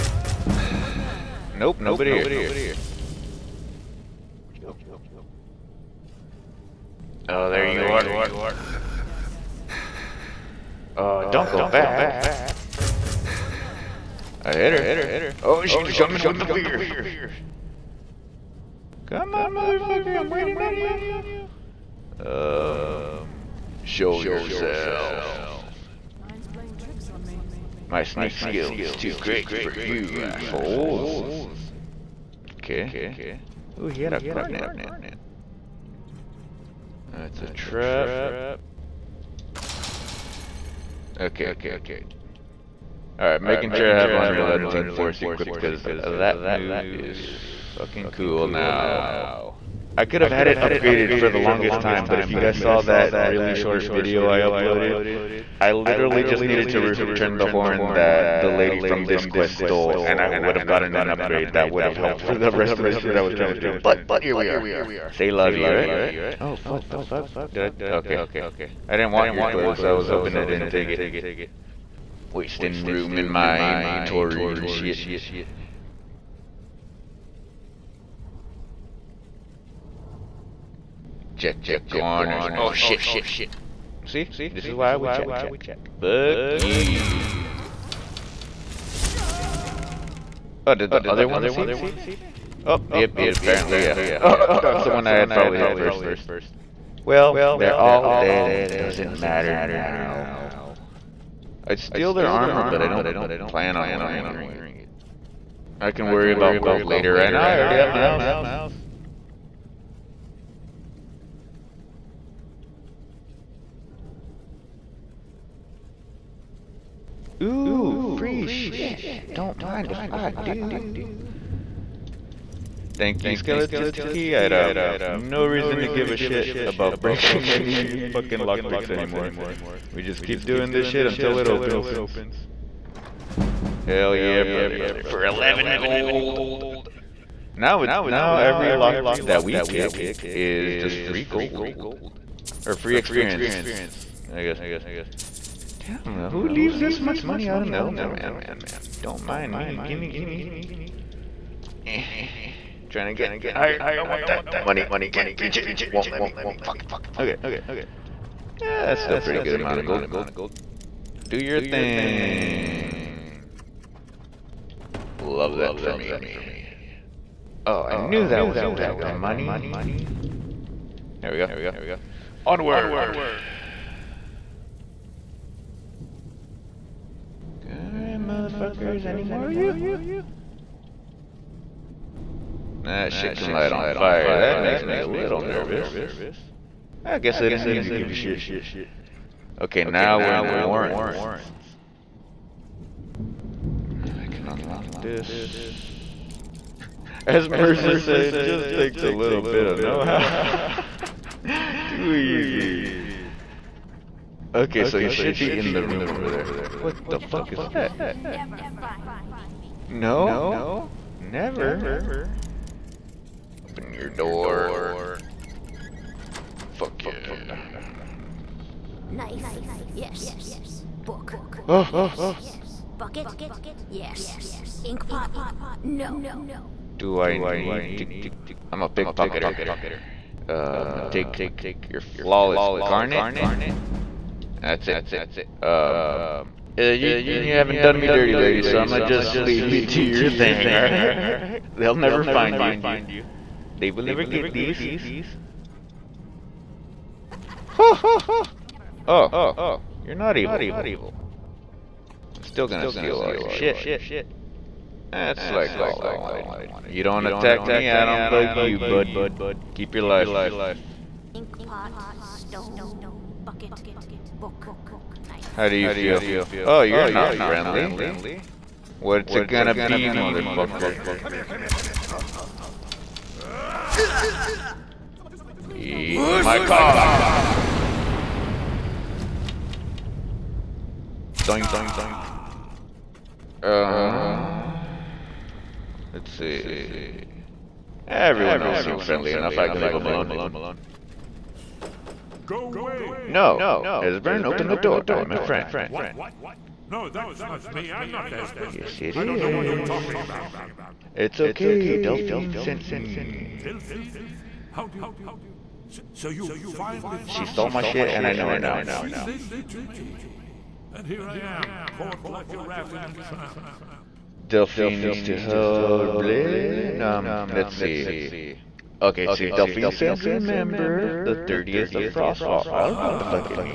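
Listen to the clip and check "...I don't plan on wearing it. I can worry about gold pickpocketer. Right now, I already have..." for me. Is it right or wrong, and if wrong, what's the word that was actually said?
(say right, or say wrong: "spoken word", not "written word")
wrong: "later", not "pickpocketer".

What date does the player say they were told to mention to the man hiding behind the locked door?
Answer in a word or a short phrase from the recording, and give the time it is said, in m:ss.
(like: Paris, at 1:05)
30th of Frostfall, at 5:21.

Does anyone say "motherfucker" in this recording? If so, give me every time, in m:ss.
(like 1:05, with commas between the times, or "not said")
0:19, 2:58, 4:30.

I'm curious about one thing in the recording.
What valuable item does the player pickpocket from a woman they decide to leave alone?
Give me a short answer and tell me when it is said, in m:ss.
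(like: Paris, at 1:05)
Flawless garnet, at 3:52.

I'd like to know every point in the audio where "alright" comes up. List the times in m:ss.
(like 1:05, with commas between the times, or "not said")
0:43, 2:57, 4:00.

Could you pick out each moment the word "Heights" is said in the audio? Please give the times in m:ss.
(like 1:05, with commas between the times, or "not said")
not said.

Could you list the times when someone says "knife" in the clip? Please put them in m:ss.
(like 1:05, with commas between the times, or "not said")
3:39, 4:25.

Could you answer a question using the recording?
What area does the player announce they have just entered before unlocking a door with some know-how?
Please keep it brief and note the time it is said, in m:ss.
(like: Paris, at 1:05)
The Warrens, at 3:10.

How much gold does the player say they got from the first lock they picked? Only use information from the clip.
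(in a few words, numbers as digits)
11 gold.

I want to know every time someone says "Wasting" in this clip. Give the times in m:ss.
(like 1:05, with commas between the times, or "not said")
1:12.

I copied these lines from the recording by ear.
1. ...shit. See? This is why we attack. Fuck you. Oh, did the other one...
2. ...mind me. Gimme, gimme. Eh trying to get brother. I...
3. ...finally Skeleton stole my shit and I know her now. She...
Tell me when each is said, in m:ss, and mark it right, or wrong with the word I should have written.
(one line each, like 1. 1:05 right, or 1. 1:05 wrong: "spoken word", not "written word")
1. 1:22 wrong: "check", not "attack"
2. 2:29 wrong: "higher", not "brother"
3. 5:06 wrong: "She", not "Skeleton".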